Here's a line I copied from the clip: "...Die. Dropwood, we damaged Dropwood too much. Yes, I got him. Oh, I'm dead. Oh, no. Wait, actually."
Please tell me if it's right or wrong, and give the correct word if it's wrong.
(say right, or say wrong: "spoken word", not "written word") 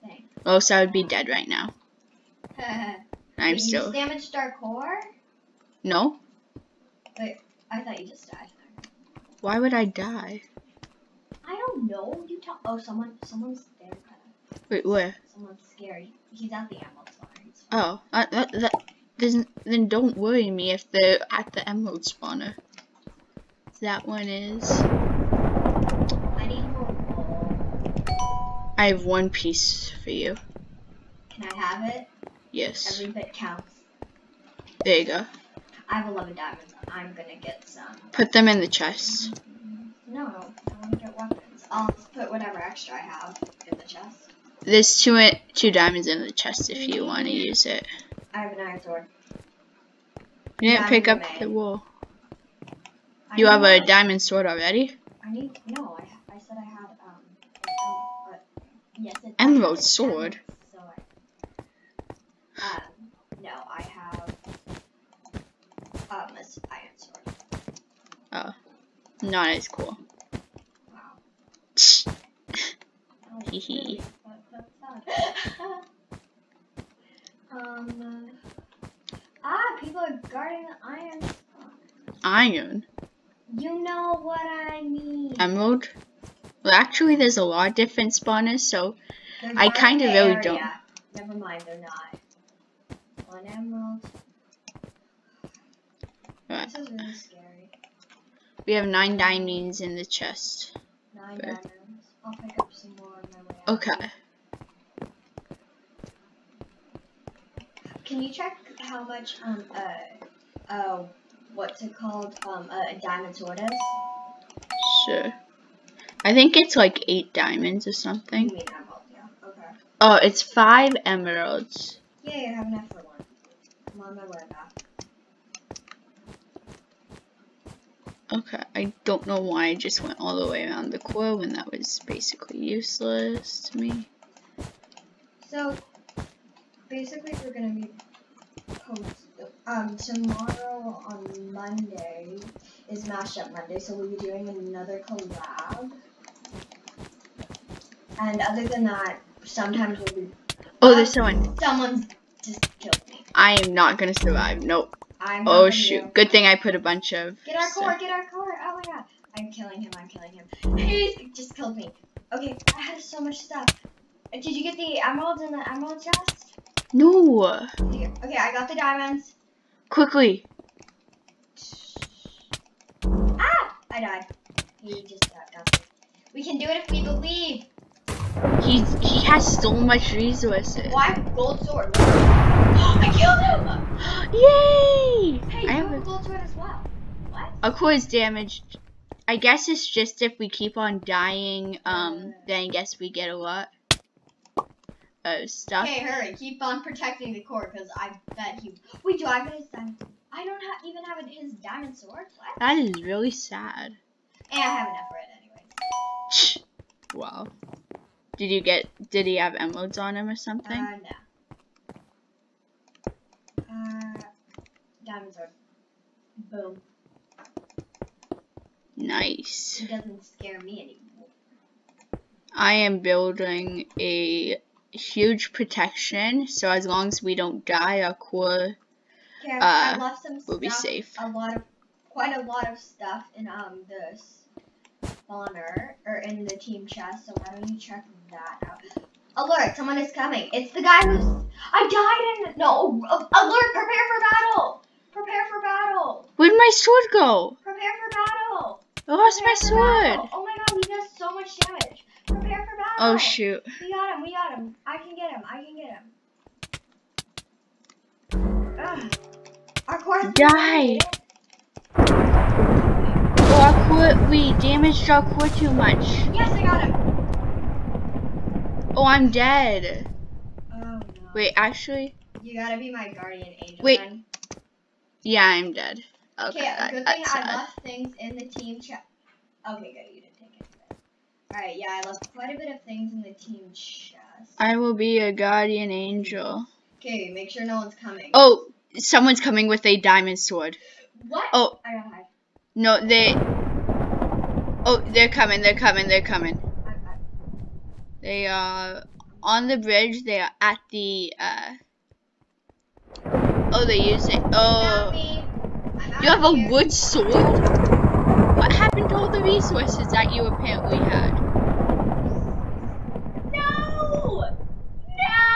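right.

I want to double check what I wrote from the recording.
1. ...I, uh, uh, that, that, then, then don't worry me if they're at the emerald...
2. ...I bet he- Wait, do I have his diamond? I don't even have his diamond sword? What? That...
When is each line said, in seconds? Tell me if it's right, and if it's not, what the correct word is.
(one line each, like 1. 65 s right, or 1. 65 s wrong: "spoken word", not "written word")
1. 18 s right
2. 197 s right.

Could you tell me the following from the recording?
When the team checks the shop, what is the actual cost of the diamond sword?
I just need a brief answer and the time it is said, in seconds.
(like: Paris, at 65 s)
5 emeralds, at 120 s.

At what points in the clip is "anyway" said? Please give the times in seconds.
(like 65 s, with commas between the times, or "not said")
206 s.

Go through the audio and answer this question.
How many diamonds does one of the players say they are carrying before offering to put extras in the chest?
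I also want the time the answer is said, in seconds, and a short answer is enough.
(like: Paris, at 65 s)
11, at 35 s.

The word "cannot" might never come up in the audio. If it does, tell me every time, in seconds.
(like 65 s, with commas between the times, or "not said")
not said.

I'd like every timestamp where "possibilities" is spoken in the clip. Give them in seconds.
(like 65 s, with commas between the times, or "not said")
not said.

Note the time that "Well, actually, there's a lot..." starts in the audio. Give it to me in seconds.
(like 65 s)
86 s.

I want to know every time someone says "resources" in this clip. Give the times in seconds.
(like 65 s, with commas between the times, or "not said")
180 s, 309 s.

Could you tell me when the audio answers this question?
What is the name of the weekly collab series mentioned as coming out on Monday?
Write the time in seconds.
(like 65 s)
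143 s.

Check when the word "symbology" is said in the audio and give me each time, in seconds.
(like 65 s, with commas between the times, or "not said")
not said.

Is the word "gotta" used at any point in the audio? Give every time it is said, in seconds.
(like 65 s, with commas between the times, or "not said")
272 s, 291 s.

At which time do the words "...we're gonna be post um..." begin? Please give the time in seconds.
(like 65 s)
137 s.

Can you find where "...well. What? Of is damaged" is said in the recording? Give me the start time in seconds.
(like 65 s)
186 s.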